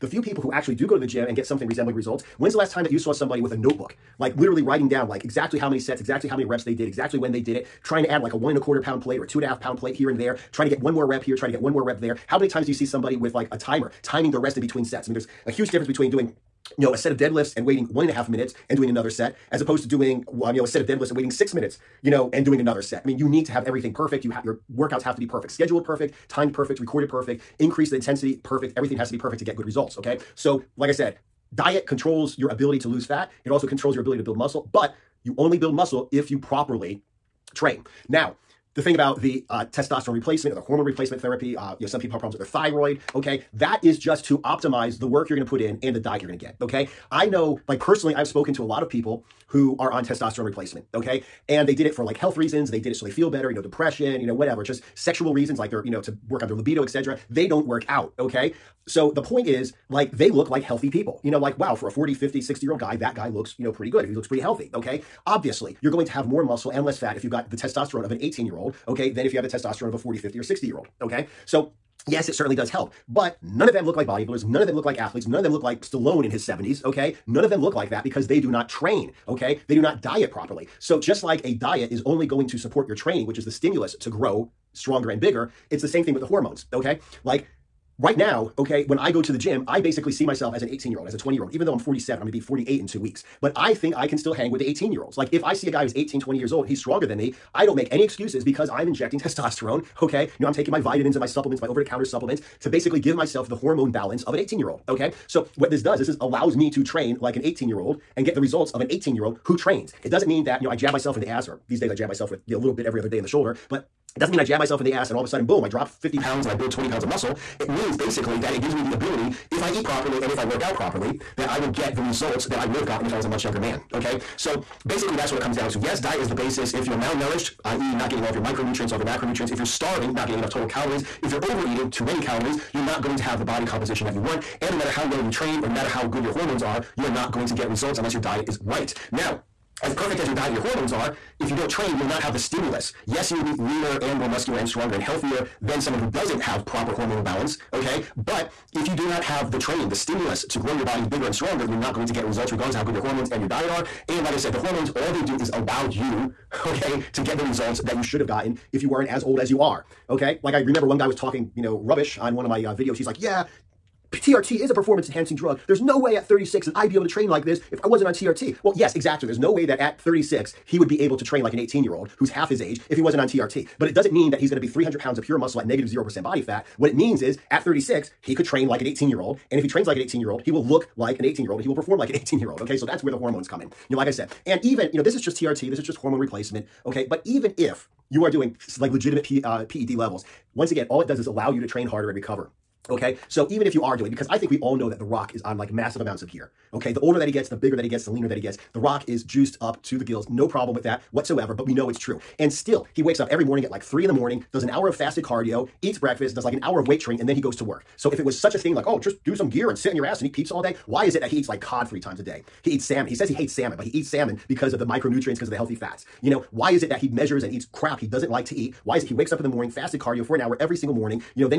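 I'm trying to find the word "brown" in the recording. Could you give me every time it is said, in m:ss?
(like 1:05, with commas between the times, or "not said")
not said.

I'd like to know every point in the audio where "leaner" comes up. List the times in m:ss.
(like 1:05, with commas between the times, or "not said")
2:23, 3:18.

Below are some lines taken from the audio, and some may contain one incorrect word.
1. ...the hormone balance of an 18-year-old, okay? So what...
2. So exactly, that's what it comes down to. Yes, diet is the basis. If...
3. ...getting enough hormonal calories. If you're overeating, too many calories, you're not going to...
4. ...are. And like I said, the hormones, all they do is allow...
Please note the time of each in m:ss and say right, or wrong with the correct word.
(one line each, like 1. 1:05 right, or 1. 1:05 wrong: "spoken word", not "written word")
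1. 1:43 right
2. 2:04 wrong: "basically", not "exactly"
3. 2:10 wrong: "total", not "hormonal"
4. 2:33 right.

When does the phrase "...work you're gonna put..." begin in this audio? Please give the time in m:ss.
0:45.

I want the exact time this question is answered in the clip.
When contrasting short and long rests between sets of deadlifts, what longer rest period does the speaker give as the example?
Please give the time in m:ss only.
0:21.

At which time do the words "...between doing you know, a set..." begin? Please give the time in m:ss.
0:15.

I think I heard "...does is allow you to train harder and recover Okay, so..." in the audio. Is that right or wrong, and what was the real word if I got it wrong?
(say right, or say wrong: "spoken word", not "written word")
right.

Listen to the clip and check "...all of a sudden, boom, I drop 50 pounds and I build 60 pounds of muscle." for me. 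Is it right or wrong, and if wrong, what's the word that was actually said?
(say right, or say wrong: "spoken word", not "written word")
wrong: "20", not "60".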